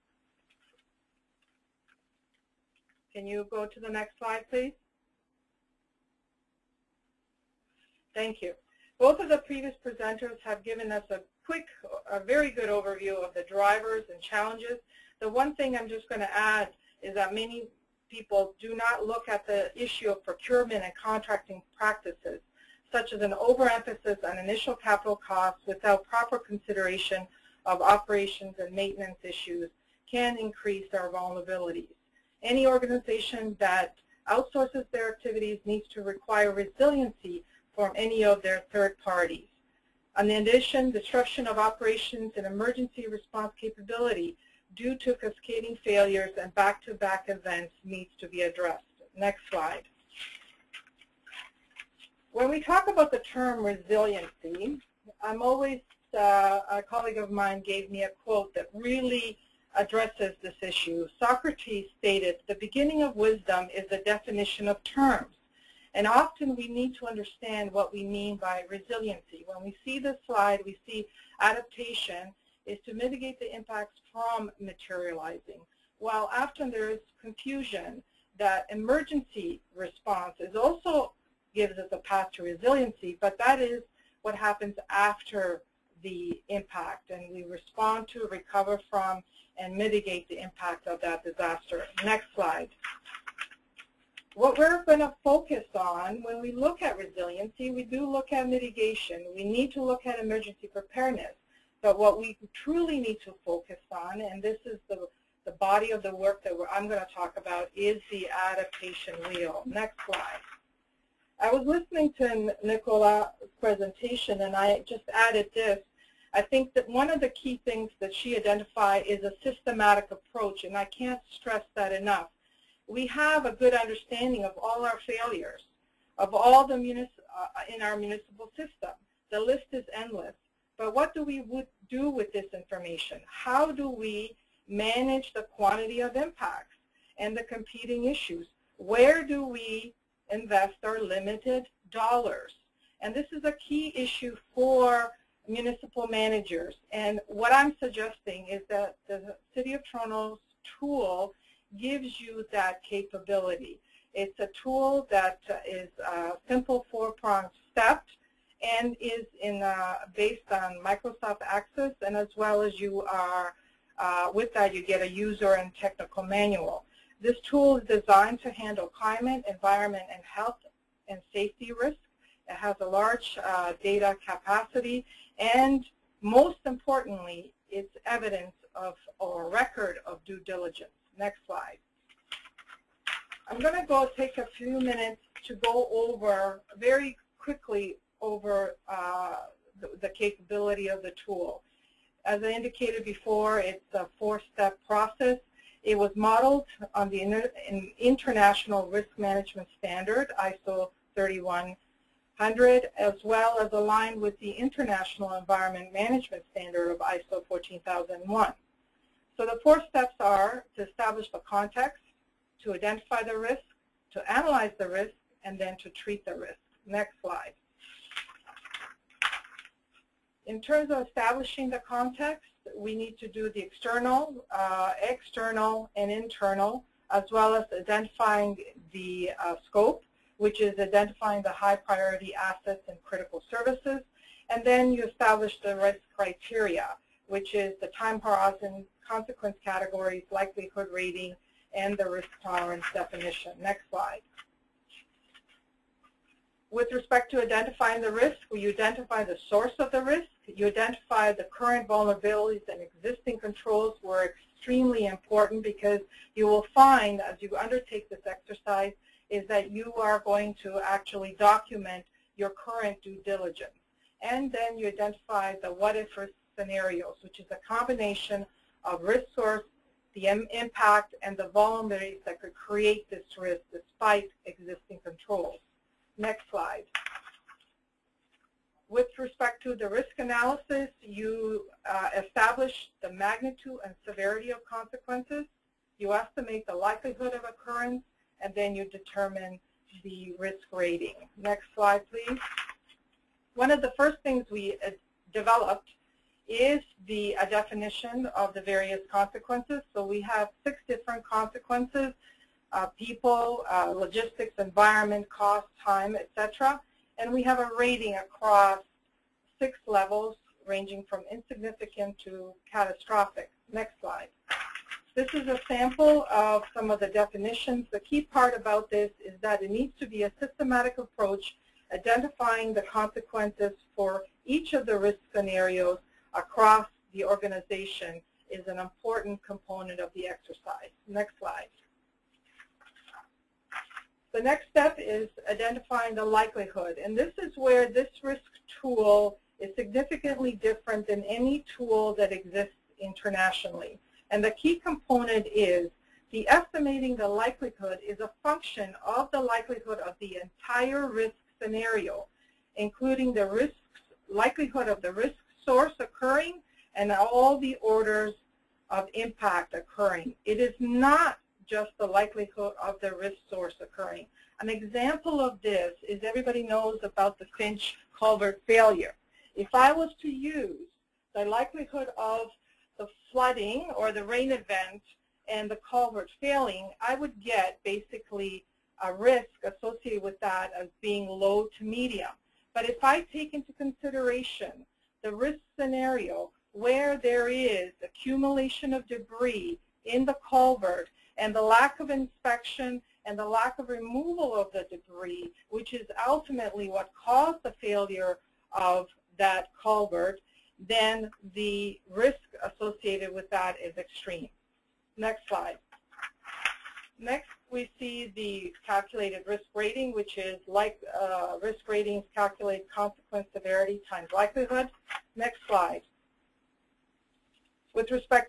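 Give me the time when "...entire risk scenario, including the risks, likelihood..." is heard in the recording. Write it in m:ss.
5:50.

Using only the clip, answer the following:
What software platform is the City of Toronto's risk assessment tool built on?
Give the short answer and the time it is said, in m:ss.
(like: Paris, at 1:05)
Microsoft Access, at 2:40.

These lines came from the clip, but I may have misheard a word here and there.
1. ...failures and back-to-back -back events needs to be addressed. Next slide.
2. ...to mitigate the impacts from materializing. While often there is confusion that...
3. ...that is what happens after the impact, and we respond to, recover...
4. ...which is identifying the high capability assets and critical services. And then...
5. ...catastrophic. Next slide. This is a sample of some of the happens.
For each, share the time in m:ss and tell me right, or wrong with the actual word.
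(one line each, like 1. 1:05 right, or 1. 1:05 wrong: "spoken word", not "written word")
1. 0:45 right
2. 1:12 right
3. 1:23 right
4. 3:50 wrong: "priority", not "capability"
5. 5:12 wrong: "definitions", not "happens".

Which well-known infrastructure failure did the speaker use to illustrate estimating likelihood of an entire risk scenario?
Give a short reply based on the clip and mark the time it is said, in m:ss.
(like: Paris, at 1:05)
Finch culvert failure, at 6:07.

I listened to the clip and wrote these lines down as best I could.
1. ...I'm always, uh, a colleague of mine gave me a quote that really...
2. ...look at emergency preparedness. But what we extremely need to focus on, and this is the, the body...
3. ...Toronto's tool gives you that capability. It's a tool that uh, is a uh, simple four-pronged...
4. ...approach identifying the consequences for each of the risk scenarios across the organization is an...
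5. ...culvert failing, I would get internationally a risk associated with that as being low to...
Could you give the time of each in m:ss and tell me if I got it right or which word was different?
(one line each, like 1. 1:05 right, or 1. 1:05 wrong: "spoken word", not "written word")
1. 0:55 right
2. 1:39 wrong: "truly", not "extremely"
3. 2:29 right
4. 5:20 right
5. 6:15 wrong: "basically", not "internationally".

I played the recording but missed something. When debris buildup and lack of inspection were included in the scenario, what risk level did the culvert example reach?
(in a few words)
extreme.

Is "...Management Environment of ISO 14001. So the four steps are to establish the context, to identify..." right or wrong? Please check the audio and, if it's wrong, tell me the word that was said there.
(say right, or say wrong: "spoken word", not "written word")
wrong: "Standard", not "Environment".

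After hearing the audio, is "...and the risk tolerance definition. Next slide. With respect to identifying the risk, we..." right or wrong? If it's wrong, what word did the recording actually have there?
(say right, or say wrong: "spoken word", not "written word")
right.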